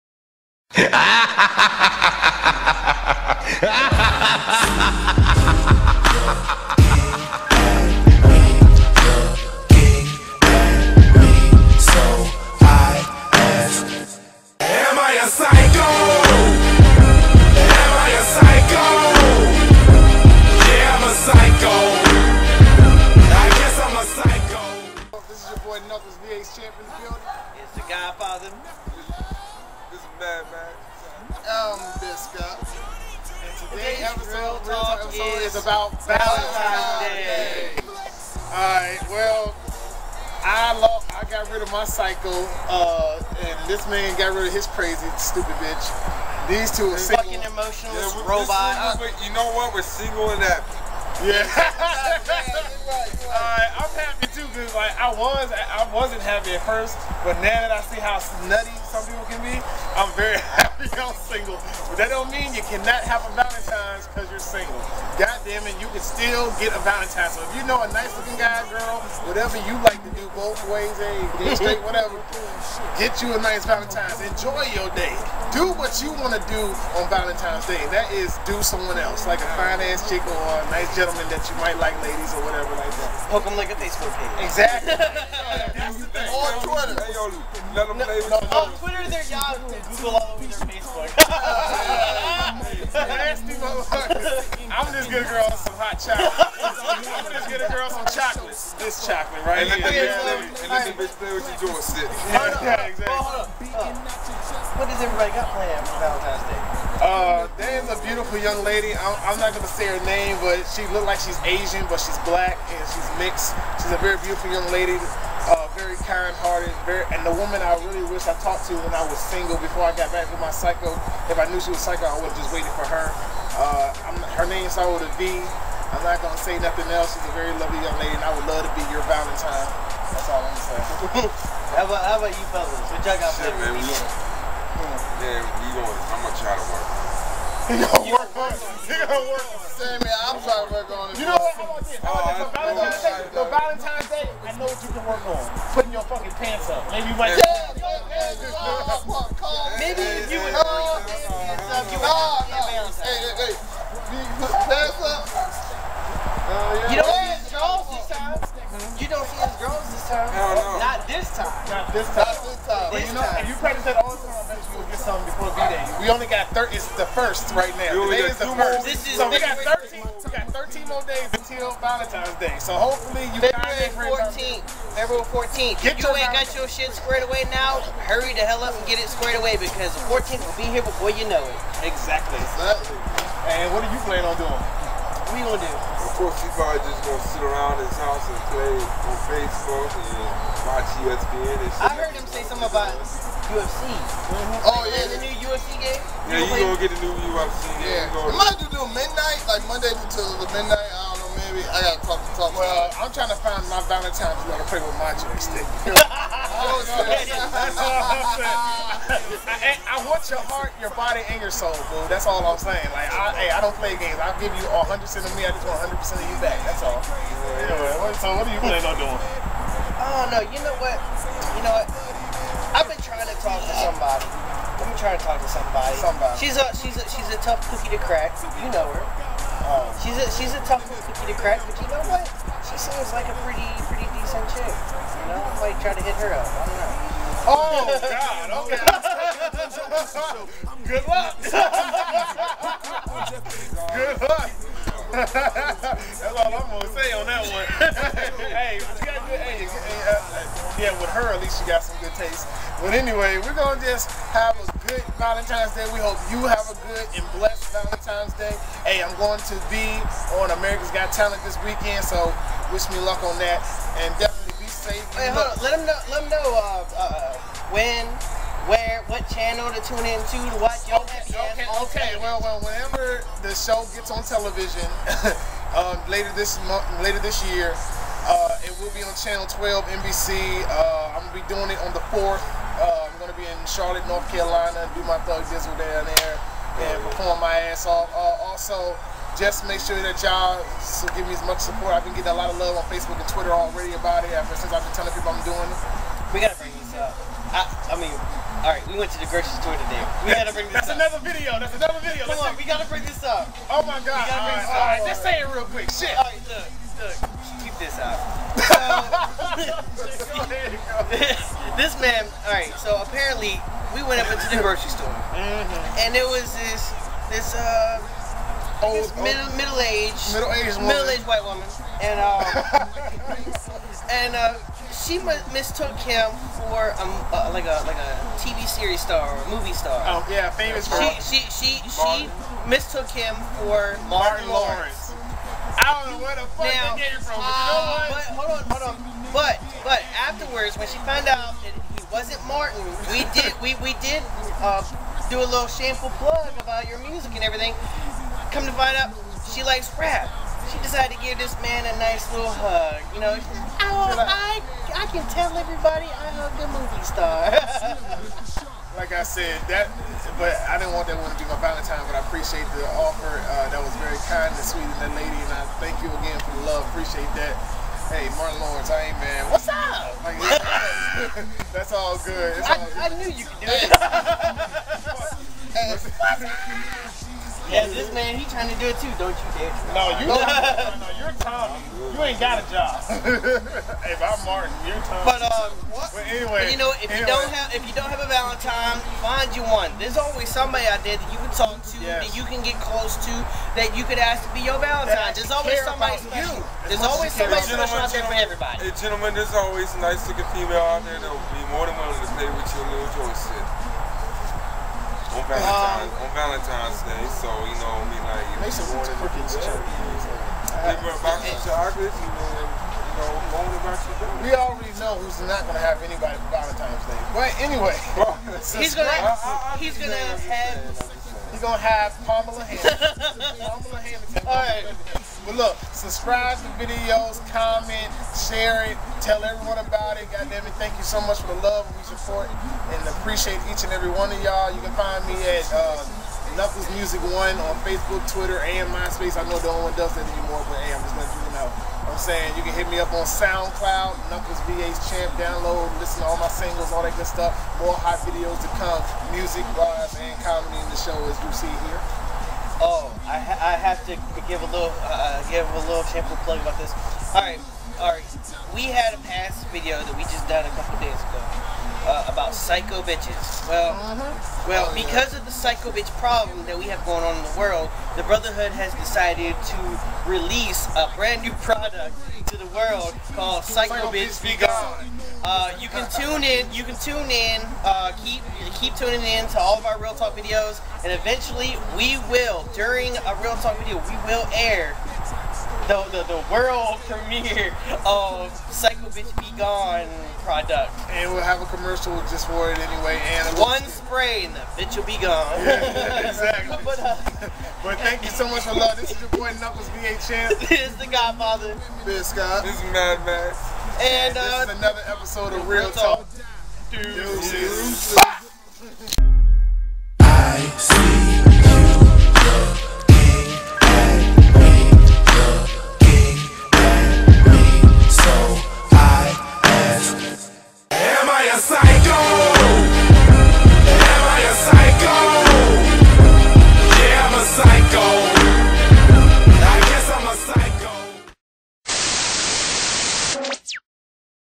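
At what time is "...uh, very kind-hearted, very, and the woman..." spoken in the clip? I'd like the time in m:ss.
1:55.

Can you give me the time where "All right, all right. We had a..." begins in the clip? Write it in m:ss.
7:37.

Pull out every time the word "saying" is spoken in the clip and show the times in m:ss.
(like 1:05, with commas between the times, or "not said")
3:28, 3:32, 7:22.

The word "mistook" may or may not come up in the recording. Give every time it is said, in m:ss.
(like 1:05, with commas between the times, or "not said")
5:25, 5:32.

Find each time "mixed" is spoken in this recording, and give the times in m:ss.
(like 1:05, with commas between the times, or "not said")
1:53.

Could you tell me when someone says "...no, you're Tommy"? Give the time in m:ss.
6:20.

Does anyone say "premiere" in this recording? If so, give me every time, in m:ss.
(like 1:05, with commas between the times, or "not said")
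8:07.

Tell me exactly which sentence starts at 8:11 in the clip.
And we'll have a commercial just for it anyway.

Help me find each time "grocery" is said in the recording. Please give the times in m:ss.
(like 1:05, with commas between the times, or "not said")
4:59, 5:14.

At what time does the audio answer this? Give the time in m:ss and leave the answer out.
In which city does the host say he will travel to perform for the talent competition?
4:43.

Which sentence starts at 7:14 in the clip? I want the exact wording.
You can find me at uh, Knuckles Music One on Facebook, Twitter, and MySpace.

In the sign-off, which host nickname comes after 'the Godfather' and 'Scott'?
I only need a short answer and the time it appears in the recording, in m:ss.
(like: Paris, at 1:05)
Mad Max, at 8:22.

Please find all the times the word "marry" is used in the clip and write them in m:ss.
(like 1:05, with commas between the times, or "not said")
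not said.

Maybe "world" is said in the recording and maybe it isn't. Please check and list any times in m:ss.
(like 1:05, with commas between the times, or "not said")
7:47, 7:52, 8:06.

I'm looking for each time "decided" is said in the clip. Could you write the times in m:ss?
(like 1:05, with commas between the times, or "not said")
5:50, 7:48.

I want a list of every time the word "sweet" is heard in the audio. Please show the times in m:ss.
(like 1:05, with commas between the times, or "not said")
6:04.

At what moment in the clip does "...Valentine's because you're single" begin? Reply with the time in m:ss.
1:03.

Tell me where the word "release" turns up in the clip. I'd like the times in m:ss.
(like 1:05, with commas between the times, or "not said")
7:50.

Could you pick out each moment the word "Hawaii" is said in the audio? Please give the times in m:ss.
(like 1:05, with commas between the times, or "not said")
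not said.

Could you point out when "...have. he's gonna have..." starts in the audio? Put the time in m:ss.
7:00.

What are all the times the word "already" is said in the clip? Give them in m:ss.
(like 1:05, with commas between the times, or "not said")
4:53, 6:54.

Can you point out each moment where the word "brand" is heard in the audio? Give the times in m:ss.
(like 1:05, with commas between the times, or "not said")
7:51.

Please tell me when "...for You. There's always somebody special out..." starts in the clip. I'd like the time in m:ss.
6:36.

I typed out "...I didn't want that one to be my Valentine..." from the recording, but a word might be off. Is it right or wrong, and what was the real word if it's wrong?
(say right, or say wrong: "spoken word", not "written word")
right.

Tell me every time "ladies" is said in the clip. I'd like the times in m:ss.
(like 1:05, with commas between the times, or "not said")
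1:22.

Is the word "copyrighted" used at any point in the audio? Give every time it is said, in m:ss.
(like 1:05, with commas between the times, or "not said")
not said.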